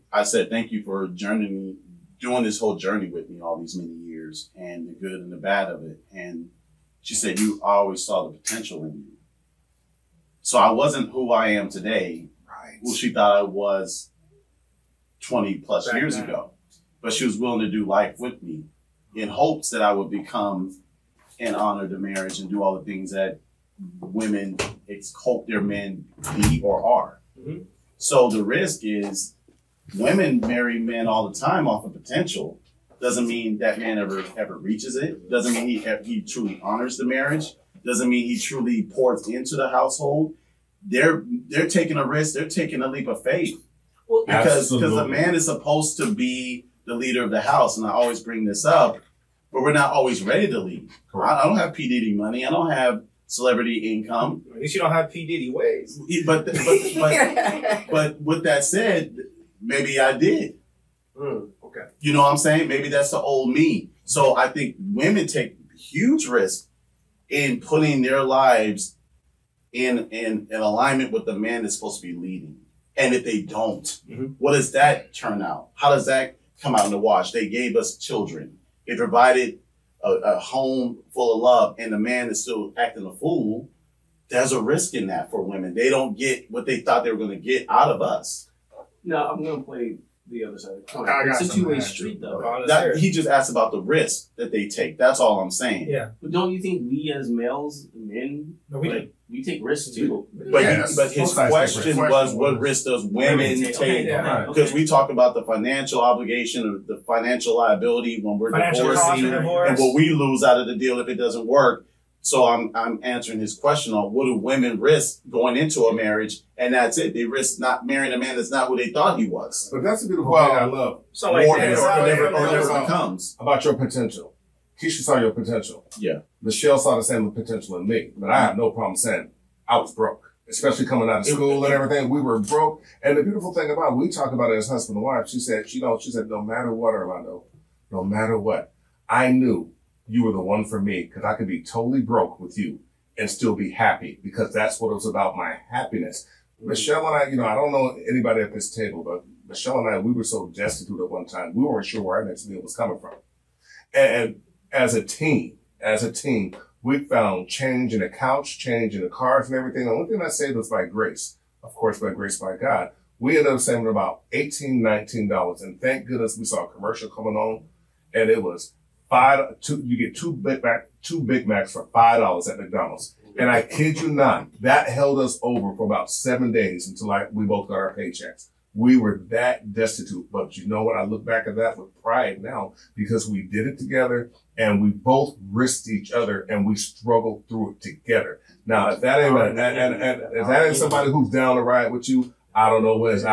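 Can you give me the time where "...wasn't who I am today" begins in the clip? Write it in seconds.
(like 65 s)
10 s.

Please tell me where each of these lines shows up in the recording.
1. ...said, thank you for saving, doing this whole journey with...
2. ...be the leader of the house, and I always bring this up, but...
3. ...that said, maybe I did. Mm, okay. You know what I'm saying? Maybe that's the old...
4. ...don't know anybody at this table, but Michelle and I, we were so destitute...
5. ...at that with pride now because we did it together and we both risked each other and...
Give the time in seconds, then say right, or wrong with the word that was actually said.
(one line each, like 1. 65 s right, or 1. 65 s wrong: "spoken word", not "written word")
1. 0 s wrong: "journeying", not "saving"
2. 46 s right
3. 58 s right
4. 147 s right
5. 181 s right.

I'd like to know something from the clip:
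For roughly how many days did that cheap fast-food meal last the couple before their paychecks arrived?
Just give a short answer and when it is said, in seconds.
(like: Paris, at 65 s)
7, at 176 s.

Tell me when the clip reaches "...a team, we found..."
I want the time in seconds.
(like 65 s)
156 s.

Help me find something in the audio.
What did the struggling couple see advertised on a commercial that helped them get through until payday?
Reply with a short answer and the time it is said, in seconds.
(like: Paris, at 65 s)
two Big Macs for $5, at 171 s.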